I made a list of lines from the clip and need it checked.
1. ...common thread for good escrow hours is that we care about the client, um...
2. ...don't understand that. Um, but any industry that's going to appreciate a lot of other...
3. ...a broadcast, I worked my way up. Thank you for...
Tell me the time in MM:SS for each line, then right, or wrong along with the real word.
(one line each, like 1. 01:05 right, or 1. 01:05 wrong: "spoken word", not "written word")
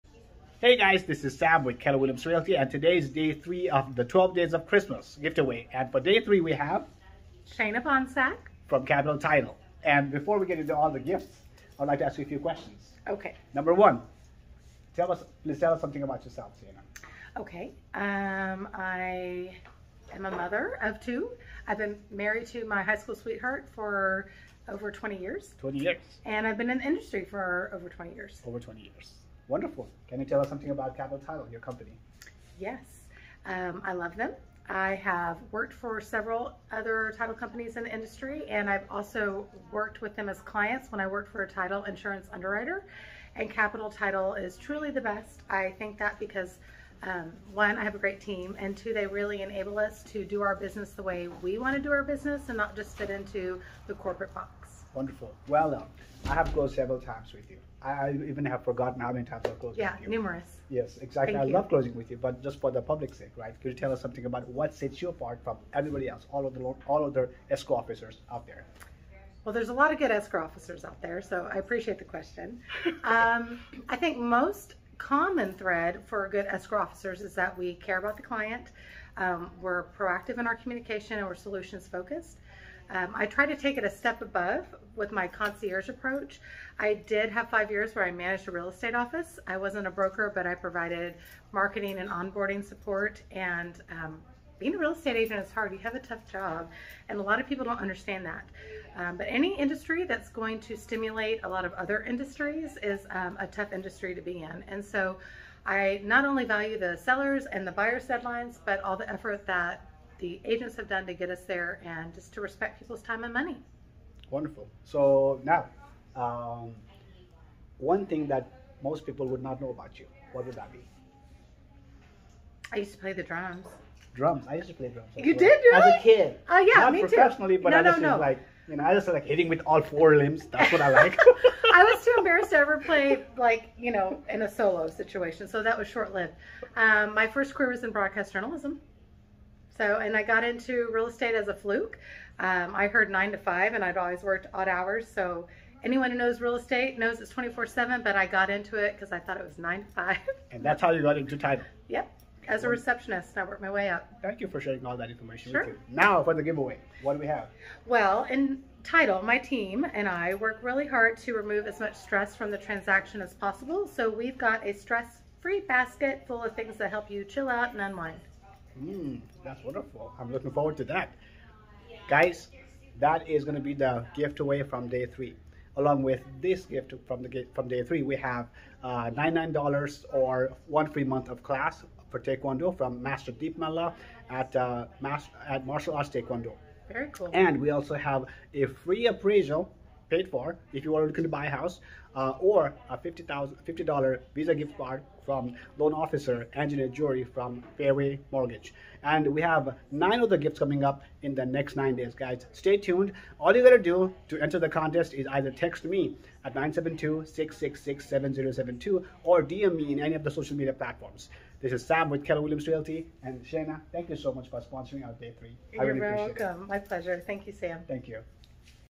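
1. 01:14 wrong: "officers", not "hours"
2. 01:37 wrong: "stimulate", not "appreciate"
3. 02:32 wrong: "receptionist", not "broadcast".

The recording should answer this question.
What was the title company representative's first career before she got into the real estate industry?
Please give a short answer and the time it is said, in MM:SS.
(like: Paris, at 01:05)
broadcast journalism, at 02:17.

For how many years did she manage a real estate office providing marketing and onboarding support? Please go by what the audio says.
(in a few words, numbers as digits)
5.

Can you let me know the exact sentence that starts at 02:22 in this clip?
Um, I heard nine to five, and I'd always worked odd hours.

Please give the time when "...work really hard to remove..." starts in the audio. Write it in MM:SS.
02:40.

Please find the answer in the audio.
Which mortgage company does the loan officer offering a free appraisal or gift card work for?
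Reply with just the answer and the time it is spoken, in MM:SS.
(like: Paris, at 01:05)
Fairway Mortgage, at 03:17.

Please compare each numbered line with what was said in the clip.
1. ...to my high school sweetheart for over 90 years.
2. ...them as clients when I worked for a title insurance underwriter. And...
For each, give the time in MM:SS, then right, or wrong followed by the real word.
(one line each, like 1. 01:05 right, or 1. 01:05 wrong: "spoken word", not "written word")
1. 00:22 wrong: "20", not "90"
2. 00:40 right.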